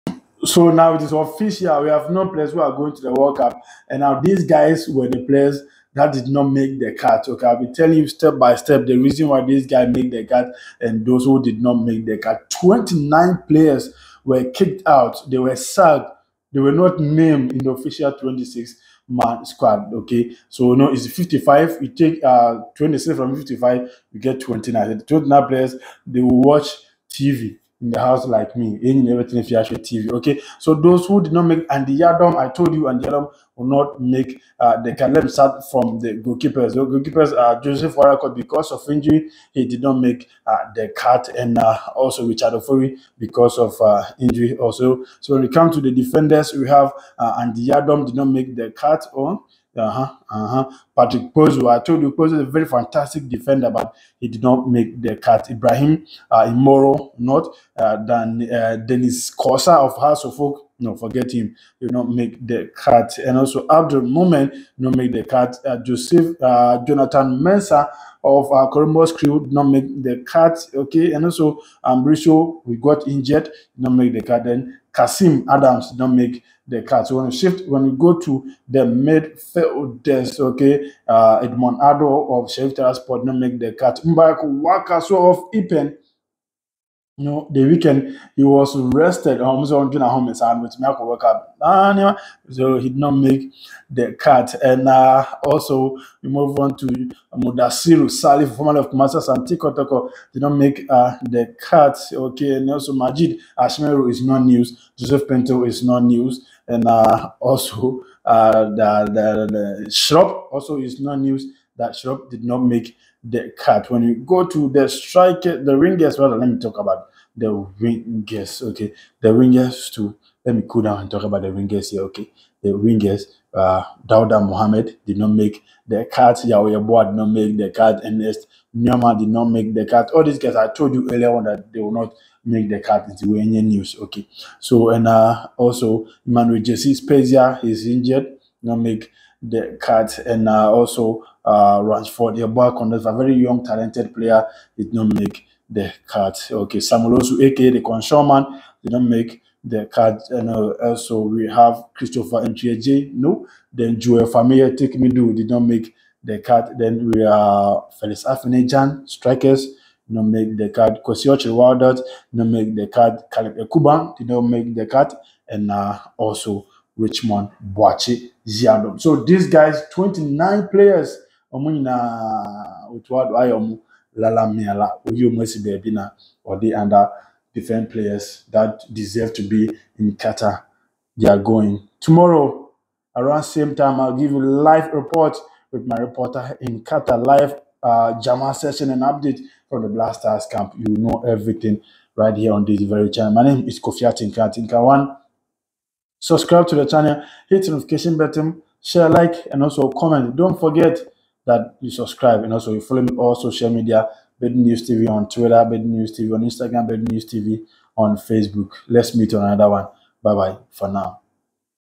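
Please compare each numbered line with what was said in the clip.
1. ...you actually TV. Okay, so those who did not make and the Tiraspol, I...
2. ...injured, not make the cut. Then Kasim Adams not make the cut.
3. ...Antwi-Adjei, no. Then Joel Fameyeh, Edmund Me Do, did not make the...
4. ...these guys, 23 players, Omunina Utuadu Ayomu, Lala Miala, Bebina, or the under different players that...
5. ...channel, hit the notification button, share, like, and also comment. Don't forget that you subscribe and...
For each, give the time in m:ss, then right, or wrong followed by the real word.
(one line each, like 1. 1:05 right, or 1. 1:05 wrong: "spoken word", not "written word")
1. 0:29 wrong: "Yadom", not "Tiraspol"
2. 1:13 right
3. 2:32 wrong: "Take", not "Edmund"
4. 2:49 wrong: "29", not "23"
5. 3:16 right.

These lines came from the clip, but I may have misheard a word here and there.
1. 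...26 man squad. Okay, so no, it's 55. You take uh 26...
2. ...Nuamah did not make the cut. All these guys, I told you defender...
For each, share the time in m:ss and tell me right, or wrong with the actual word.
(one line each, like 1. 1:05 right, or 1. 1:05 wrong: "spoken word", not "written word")
1. 0:18 right
2. 2:08 wrong: "earlier", not "defender".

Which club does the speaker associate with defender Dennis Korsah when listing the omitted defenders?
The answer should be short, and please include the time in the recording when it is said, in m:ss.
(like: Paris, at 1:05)
Hearts of Oak, at 0:59.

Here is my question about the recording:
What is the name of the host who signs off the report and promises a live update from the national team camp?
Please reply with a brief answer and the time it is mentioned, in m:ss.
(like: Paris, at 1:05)
Kofi Atinka, at 3:13.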